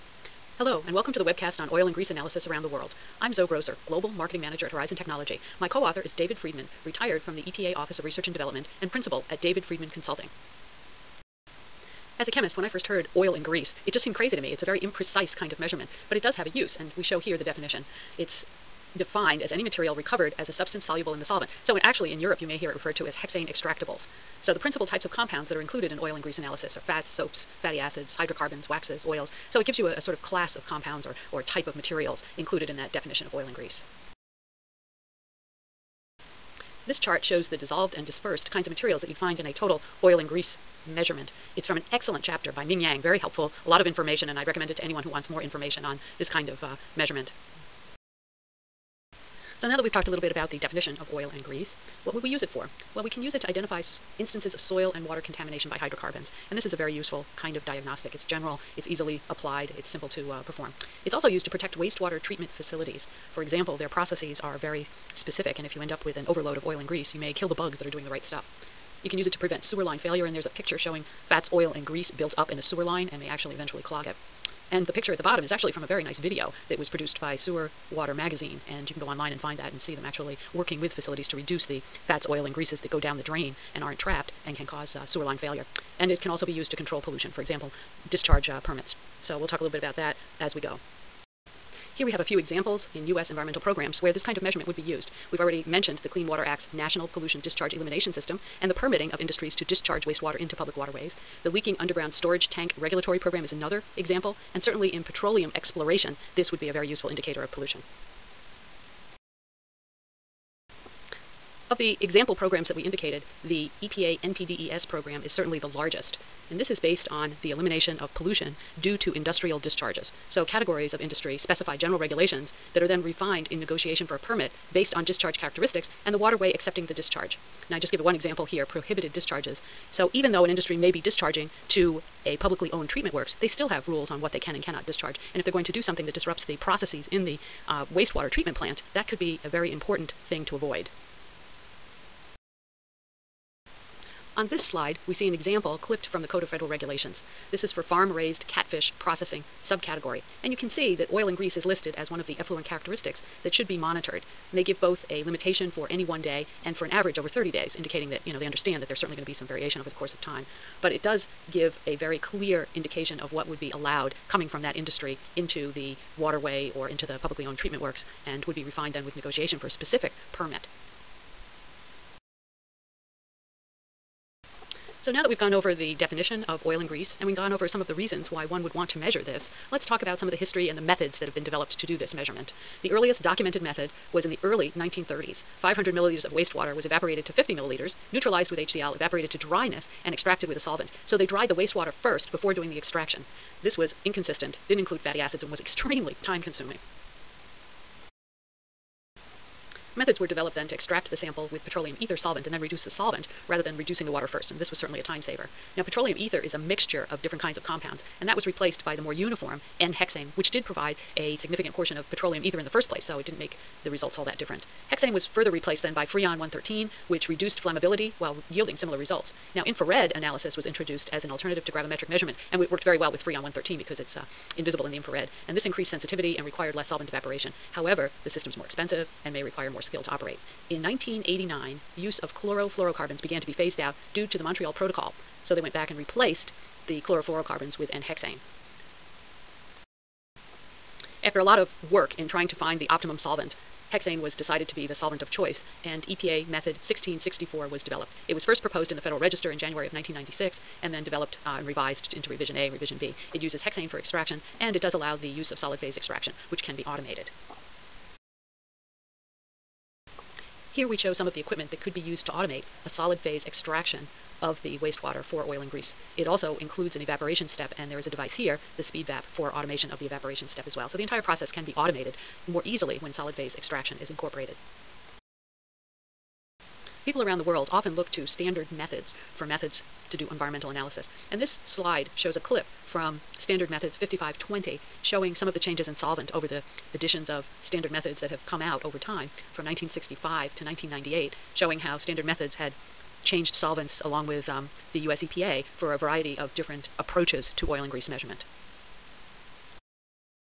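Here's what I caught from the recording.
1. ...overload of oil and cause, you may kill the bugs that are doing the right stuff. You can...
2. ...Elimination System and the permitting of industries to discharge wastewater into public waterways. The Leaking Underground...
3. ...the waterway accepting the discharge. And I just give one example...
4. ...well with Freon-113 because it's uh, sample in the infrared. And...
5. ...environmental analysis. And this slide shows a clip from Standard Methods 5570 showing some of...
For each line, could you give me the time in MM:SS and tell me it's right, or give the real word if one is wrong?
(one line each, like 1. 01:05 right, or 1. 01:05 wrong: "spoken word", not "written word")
1. 01:06 wrong: "grease", not "cause"
2. 01:37 right
3. 02:06 right
4. 03:42 wrong: "invisible", not "sample"
5. 04:40 wrong: "5520", not "5570".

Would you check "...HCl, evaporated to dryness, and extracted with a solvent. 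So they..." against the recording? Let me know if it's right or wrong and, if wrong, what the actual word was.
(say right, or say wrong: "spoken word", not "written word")
right.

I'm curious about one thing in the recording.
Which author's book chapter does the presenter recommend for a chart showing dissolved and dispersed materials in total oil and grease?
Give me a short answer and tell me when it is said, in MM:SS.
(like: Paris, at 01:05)
Ming Yang, at 00:42.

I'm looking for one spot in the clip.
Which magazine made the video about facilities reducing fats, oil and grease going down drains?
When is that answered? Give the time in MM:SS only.
01:17.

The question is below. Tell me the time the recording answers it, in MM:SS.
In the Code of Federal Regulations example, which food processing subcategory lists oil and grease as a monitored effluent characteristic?
02:27.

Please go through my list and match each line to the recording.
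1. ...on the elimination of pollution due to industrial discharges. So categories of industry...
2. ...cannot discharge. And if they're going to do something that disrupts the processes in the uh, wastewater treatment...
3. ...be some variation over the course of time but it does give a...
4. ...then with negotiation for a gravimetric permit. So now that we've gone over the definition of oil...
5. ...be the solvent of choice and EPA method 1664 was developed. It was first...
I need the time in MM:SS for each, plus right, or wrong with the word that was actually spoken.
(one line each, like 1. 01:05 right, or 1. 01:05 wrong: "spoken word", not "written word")
1. 01:57 right
2. 02:14 right
3. 02:39 right
4. 02:48 wrong: "specific", not "gravimetric"
5. 04:04 right.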